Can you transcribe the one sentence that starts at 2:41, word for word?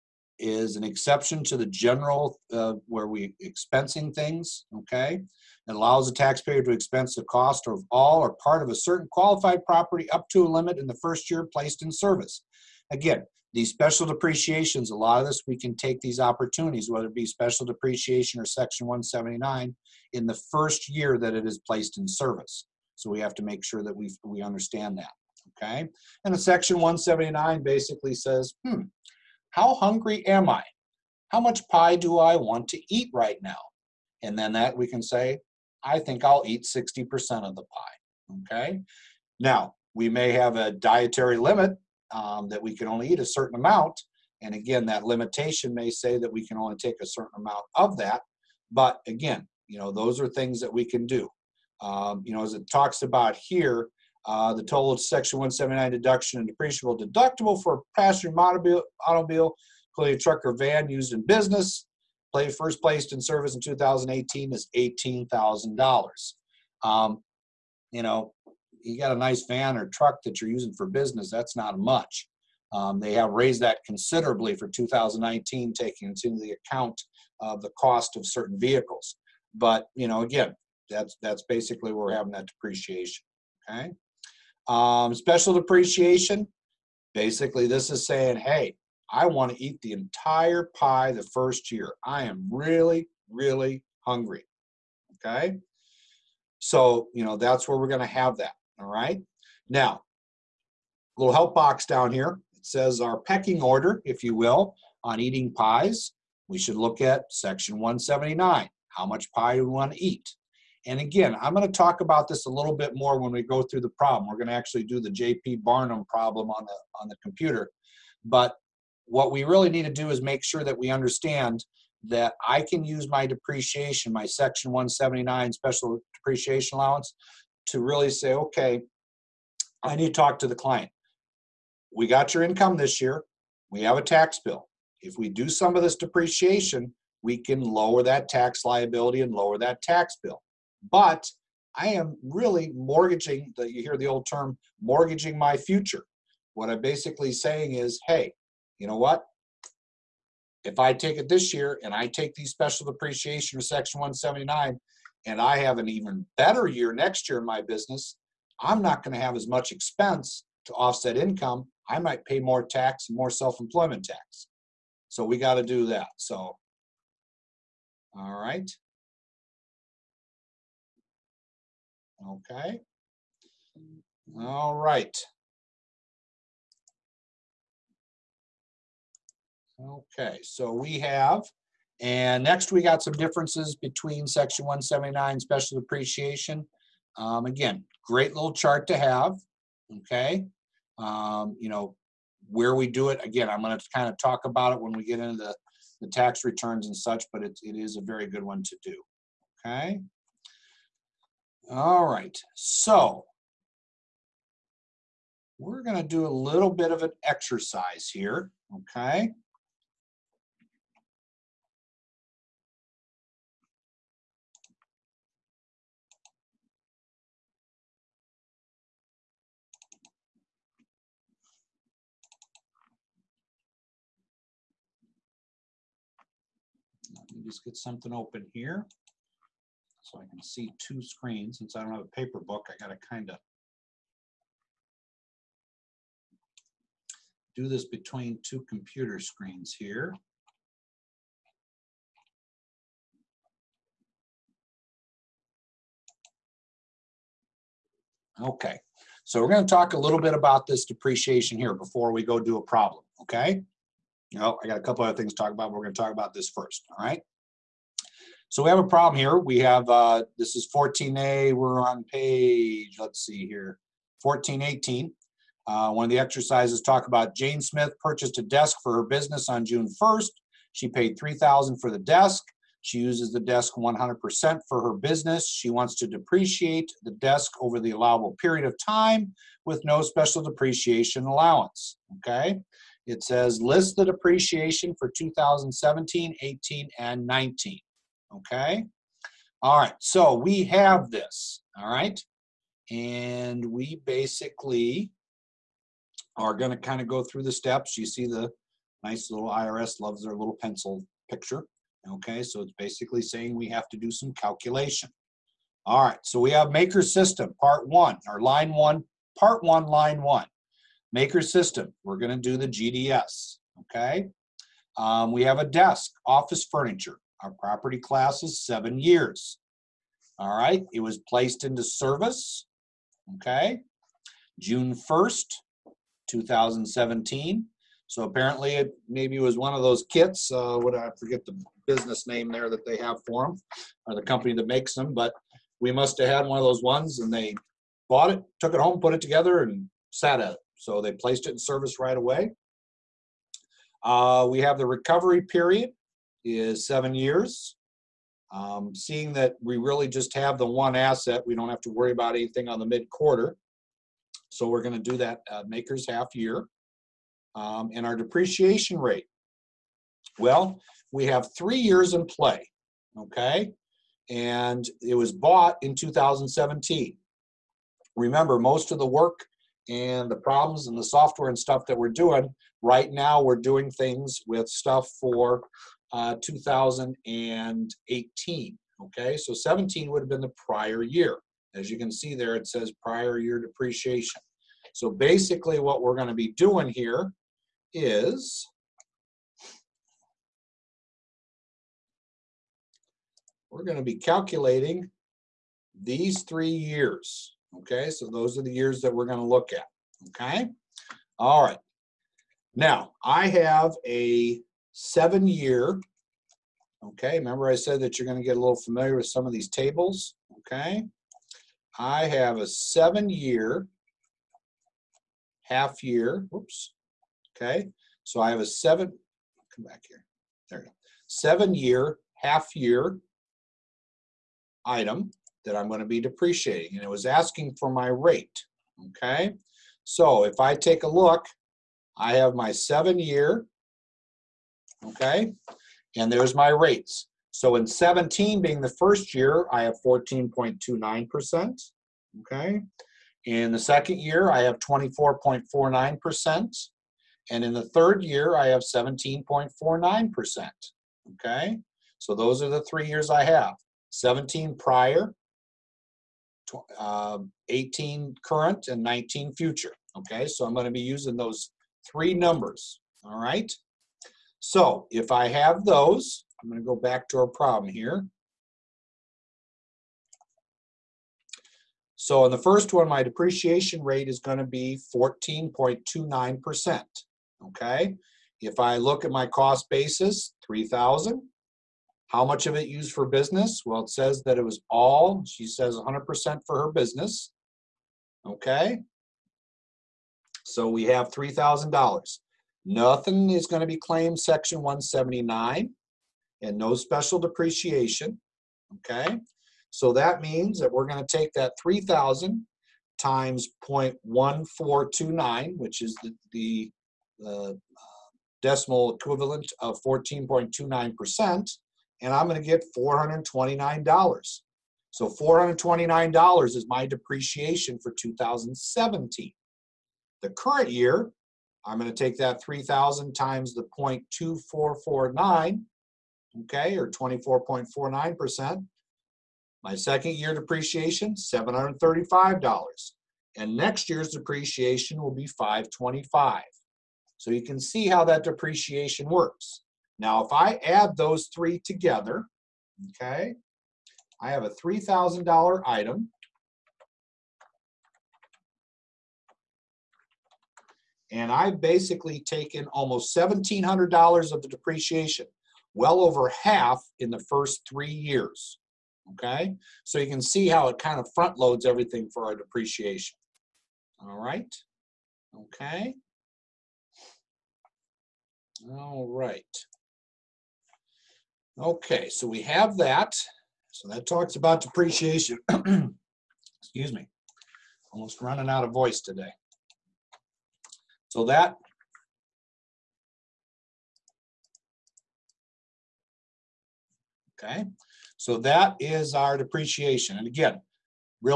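I might pay more tax and more self employment tax.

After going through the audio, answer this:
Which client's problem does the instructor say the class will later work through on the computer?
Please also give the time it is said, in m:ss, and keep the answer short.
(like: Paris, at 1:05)
J.P. Barnum, at 1:55.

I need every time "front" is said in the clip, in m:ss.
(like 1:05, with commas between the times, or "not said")
9:21.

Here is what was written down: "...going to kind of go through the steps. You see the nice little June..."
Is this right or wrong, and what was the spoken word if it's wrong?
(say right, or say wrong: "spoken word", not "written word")
wrong: "IRS", not "June".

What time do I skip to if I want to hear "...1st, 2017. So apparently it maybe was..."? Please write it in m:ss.
5:24.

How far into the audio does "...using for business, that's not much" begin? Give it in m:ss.
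1:10.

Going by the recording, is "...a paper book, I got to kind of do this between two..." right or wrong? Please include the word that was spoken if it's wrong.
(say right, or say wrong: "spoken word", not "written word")
right.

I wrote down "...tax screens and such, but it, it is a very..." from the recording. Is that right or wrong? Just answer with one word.
wrong.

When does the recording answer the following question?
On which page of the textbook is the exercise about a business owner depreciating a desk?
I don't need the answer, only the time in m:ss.
4:24.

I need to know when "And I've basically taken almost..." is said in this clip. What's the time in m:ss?
9:11.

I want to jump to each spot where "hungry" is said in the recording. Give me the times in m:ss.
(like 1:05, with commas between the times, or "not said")
0:29, 1:34.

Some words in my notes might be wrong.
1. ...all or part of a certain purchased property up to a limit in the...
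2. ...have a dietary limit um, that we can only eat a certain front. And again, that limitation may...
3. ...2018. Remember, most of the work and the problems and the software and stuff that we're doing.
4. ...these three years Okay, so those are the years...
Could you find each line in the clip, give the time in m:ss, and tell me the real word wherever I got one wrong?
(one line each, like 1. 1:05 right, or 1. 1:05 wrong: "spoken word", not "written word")
1. 0:07 wrong: "qualified", not "purchased"
2. 0:40 wrong: "amount", not "front"
3. 6:05 wrong: "2017", not "2018"
4. 6:36 right.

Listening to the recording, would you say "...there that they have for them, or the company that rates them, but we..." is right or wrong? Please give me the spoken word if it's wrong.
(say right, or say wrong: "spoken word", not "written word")
wrong: "makes", not "rates".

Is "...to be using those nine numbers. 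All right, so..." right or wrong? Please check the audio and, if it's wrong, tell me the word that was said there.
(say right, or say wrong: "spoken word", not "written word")
wrong: "three", not "nine".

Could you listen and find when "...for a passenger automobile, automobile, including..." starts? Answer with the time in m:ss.
0:57.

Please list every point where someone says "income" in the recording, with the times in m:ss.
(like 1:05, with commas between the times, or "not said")
2:12, 2:41.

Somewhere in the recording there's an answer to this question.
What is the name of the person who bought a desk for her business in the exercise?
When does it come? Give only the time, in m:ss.
4:27.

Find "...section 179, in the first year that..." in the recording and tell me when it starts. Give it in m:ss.
0:18.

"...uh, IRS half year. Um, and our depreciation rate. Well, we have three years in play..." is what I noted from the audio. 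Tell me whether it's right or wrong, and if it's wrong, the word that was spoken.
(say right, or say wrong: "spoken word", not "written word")
wrong: "MACRS", not "IRS".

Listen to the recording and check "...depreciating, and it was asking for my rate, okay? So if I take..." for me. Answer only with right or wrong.
right.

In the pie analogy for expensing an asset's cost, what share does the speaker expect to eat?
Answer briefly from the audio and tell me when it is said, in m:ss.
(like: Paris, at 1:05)
60%, at 0:36.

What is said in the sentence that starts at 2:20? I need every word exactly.
But I am really mortgaging the, you hear the old term mortgaging my future.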